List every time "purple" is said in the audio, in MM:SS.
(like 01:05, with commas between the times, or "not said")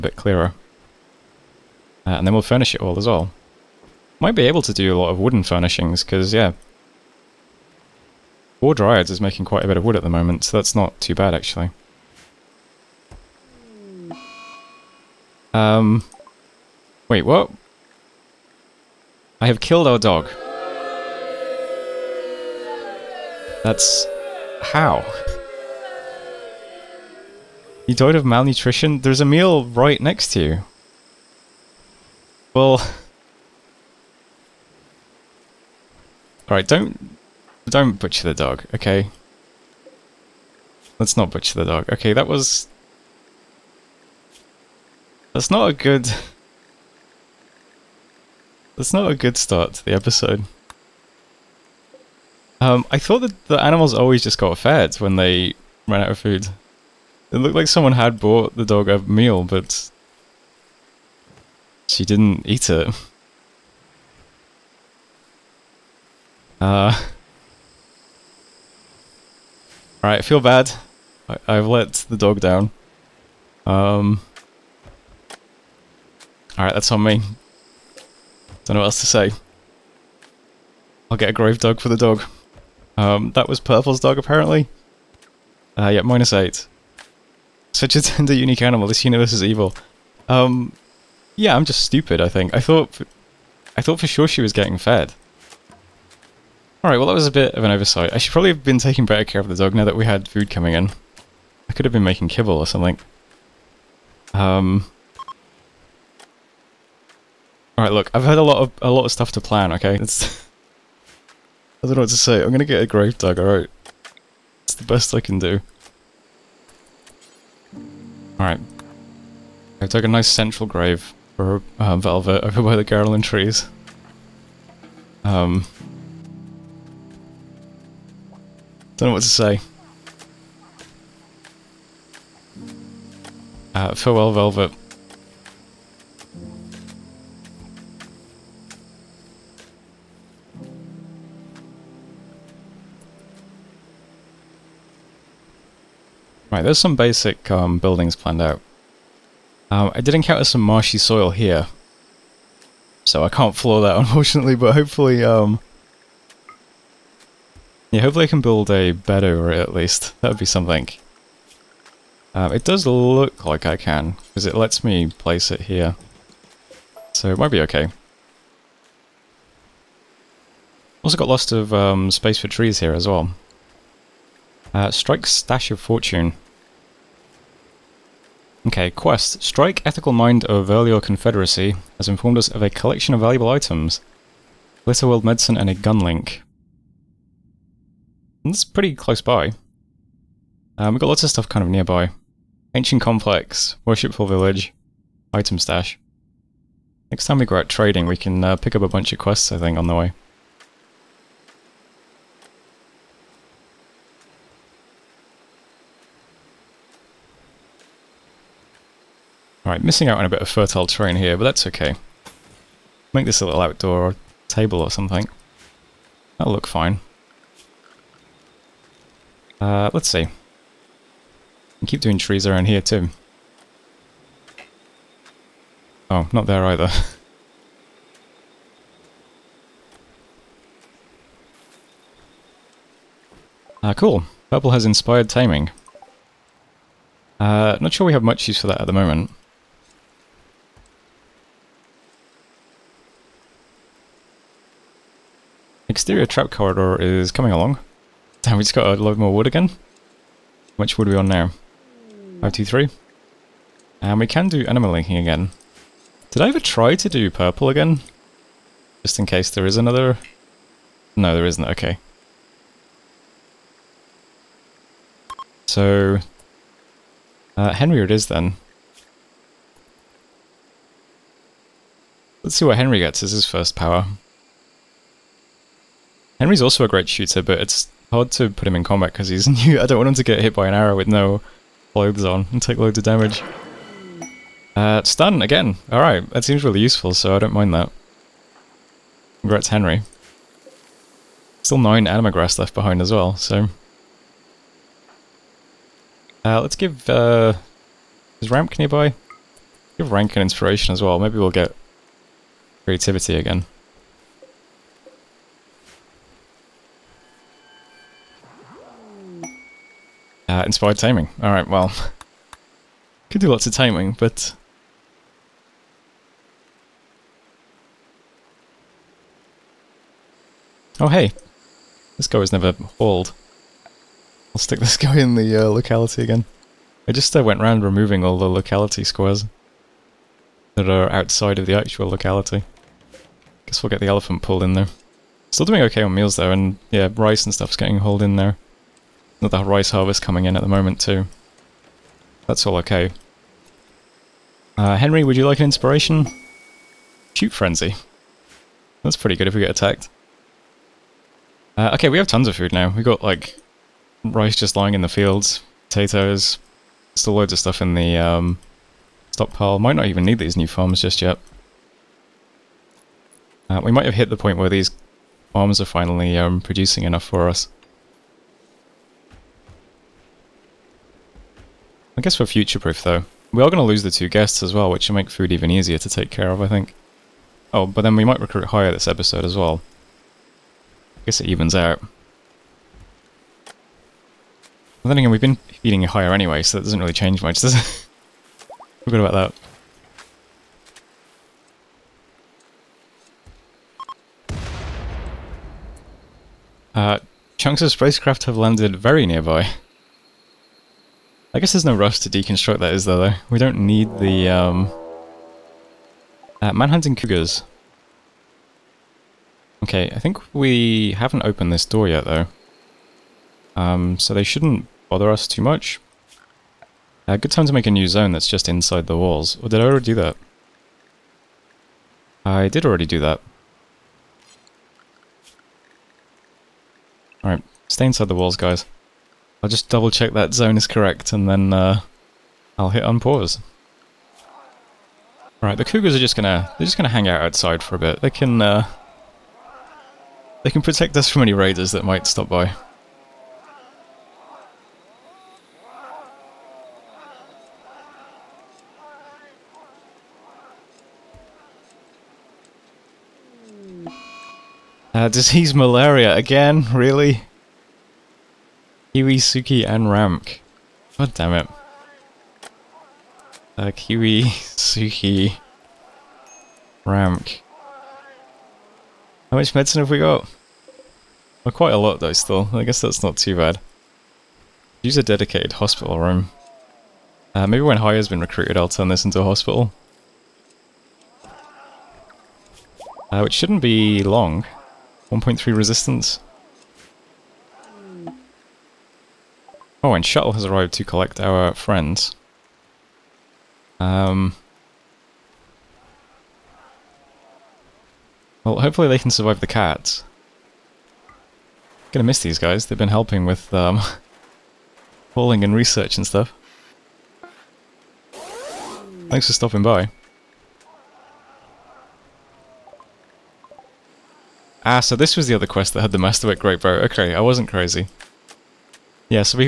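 01:23, 03:54, 04:17.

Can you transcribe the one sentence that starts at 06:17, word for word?
Oh, but then we might recruit higher this episode as well.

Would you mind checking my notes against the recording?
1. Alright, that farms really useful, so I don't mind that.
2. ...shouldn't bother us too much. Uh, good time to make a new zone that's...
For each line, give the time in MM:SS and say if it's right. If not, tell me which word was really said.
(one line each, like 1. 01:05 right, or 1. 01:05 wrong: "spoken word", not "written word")
1. 04:45 wrong: "seems", not "farms"
2. 06:54 right.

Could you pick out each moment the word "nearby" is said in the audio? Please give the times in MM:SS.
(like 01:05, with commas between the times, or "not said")
03:11, 04:58, 06:39.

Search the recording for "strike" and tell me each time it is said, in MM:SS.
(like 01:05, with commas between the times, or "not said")
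02:54, 02:59.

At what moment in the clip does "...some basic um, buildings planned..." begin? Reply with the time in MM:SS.
02:26.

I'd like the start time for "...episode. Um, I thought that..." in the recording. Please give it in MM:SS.
00:49.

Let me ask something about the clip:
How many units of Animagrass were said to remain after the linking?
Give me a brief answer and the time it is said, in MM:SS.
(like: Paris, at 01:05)
9, at 04:51.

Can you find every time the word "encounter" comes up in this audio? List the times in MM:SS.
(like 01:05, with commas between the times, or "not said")
02:30.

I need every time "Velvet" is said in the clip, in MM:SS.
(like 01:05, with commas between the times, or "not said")
02:01, 02:14.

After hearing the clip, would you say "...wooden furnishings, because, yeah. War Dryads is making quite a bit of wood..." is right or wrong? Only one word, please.
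right.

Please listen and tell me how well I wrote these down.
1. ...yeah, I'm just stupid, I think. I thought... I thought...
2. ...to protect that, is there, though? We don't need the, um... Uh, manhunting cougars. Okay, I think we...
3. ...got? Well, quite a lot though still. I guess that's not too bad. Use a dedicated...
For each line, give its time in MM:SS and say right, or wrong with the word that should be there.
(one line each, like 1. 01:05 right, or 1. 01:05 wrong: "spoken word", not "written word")
1. 01:31 right
2. 06:42 wrong: "deconstruct", not "protect"
3. 07:50 right.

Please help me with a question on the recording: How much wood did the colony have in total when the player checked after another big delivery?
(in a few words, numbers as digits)
523.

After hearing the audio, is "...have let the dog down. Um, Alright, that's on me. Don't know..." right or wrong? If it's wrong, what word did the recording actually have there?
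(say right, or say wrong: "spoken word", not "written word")
right.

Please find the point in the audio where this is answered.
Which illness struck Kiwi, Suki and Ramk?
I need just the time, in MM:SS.
07:35.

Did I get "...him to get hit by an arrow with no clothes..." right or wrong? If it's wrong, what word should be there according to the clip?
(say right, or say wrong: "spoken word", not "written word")
right.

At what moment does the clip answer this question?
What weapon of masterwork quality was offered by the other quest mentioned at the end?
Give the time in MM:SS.
08:36.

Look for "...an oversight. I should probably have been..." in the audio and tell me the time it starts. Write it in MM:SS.
01:37.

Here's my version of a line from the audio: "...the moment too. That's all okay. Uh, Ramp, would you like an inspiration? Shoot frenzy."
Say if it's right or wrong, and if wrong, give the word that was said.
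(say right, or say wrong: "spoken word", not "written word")
wrong: "Henry", not "Ramp".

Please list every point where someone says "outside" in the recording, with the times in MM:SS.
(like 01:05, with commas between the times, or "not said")
05:31, 07:17.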